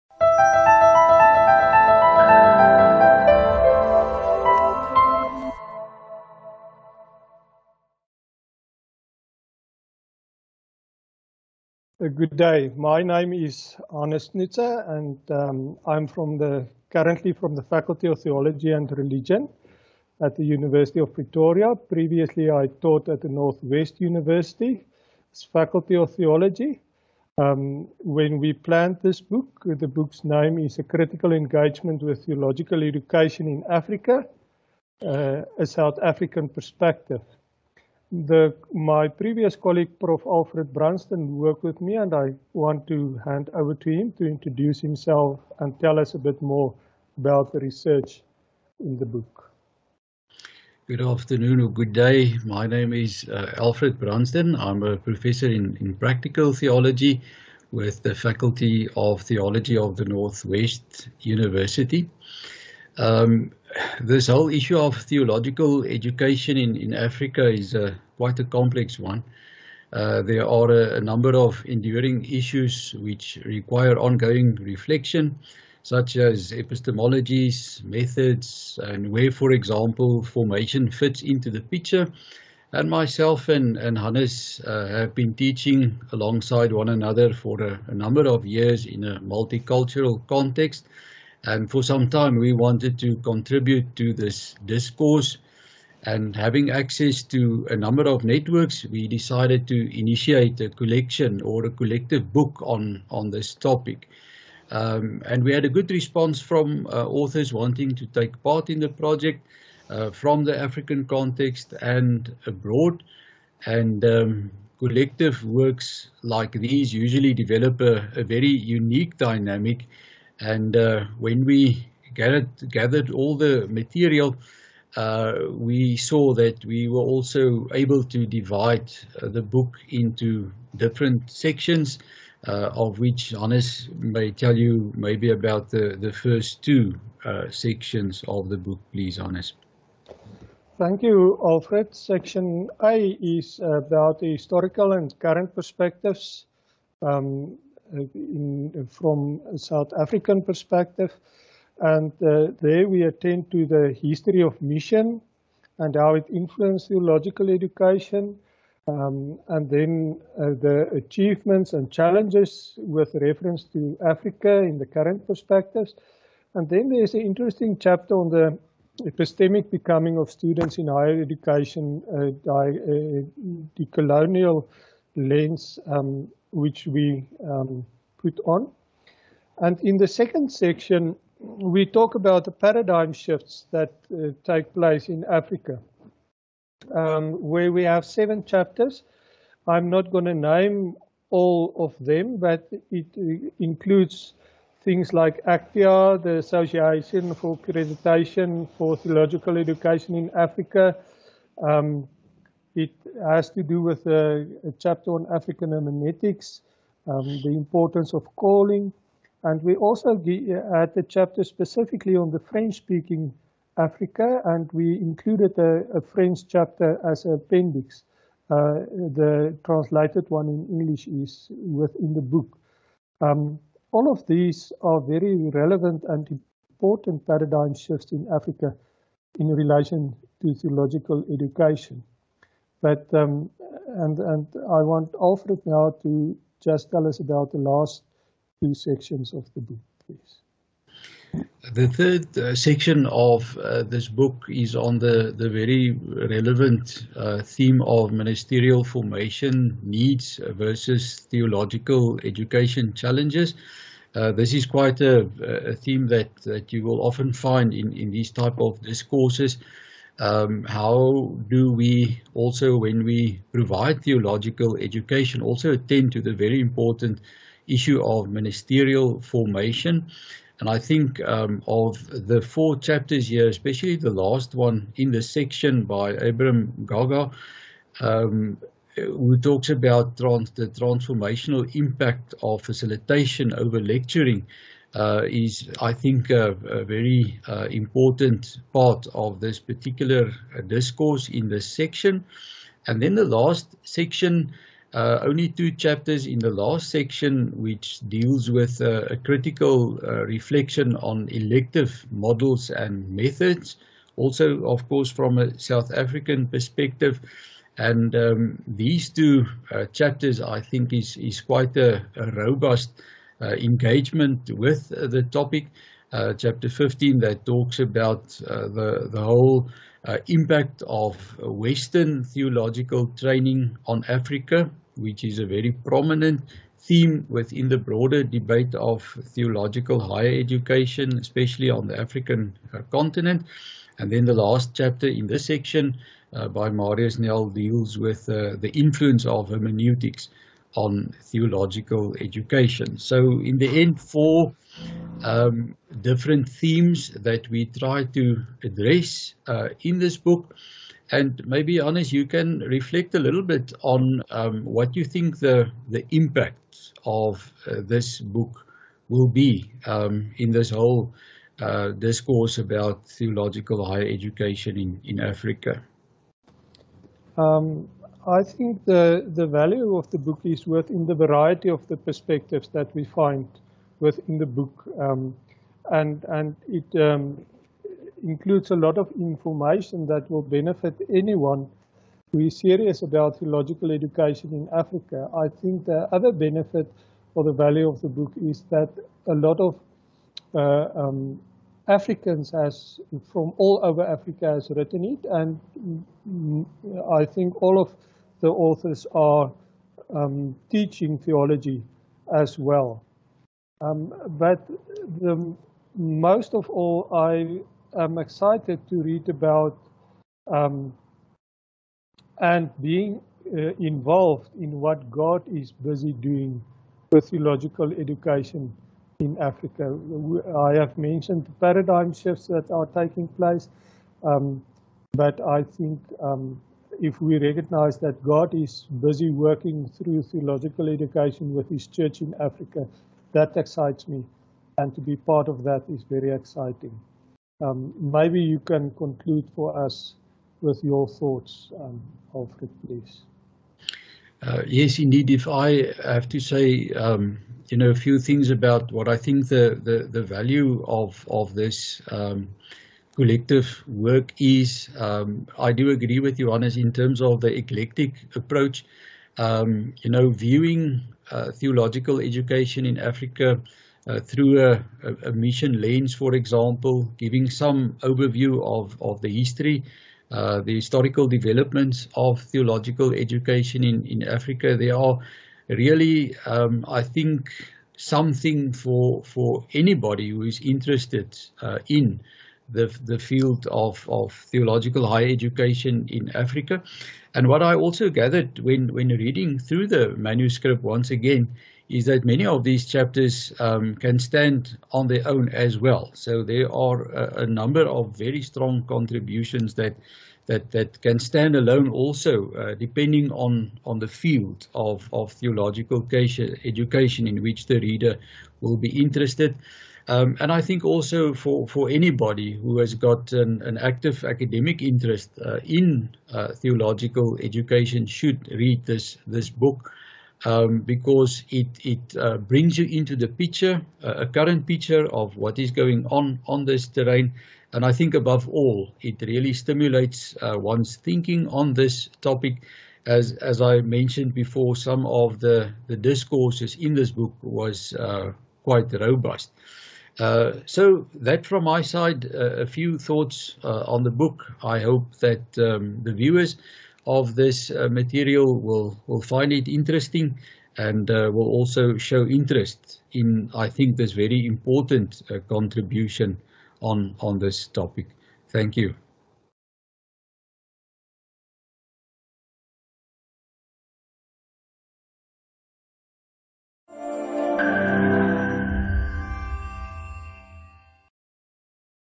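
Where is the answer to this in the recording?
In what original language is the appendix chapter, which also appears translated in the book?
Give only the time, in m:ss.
3:35.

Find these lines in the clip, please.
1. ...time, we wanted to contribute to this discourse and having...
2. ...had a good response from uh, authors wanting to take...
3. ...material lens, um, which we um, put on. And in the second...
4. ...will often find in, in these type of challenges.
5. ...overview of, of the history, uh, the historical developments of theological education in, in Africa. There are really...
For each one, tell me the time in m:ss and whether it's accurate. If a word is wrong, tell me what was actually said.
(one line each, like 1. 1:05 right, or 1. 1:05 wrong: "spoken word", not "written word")
1. 1:32 right
2. 1:45 right
3. 2:53 wrong: "colonial", not "material"
4. 4:16 wrong: "discourses", not "challenges"
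5. 7:48 right.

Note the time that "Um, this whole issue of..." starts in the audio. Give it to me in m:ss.
1:02.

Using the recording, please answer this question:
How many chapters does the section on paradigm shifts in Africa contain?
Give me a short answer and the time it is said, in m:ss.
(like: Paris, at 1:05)
7, at 3:08.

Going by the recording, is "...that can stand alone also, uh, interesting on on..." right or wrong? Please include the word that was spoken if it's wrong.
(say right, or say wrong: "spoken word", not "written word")
wrong: "depending", not "interesting".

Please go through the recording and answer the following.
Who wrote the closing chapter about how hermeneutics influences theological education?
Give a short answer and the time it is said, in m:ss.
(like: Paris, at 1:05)
Marius Nel, at 5:36.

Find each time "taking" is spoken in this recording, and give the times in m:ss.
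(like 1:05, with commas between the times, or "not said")
7:02.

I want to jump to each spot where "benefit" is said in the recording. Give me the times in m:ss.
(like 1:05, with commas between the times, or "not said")
6:20, 6:26.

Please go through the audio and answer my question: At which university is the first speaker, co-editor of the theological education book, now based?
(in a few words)
University of Pretoria.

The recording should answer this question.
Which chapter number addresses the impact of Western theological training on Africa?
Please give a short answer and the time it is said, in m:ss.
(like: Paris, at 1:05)
15, at 5:16.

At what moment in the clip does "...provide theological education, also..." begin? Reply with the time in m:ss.
4:23.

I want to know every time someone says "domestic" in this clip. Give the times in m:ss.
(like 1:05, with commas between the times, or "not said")
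not said.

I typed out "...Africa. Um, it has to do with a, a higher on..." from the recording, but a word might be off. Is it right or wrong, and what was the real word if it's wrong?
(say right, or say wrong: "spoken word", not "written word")
wrong: "chapter", not "higher".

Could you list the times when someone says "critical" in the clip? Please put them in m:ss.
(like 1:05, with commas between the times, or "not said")
0:30, 4:59.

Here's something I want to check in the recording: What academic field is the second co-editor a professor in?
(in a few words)
Practical theology.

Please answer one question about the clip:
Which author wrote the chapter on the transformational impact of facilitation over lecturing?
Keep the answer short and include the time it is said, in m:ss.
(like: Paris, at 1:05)
Abram Gaga, at 4:36.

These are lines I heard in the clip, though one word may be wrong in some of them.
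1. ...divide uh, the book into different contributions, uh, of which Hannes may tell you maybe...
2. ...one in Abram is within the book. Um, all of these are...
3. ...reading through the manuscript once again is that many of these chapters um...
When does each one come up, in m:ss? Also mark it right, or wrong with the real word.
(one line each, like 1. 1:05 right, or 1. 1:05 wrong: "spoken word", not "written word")
1. 2:08 wrong: "sections", not "contributions"
2. 3:40 wrong: "English", not "Abram"
3. 8:09 right.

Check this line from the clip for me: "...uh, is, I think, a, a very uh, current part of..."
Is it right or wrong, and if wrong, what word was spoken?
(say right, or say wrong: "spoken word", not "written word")
wrong: "important", not "current".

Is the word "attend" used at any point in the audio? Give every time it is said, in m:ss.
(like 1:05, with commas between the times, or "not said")
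2:33, 4:25.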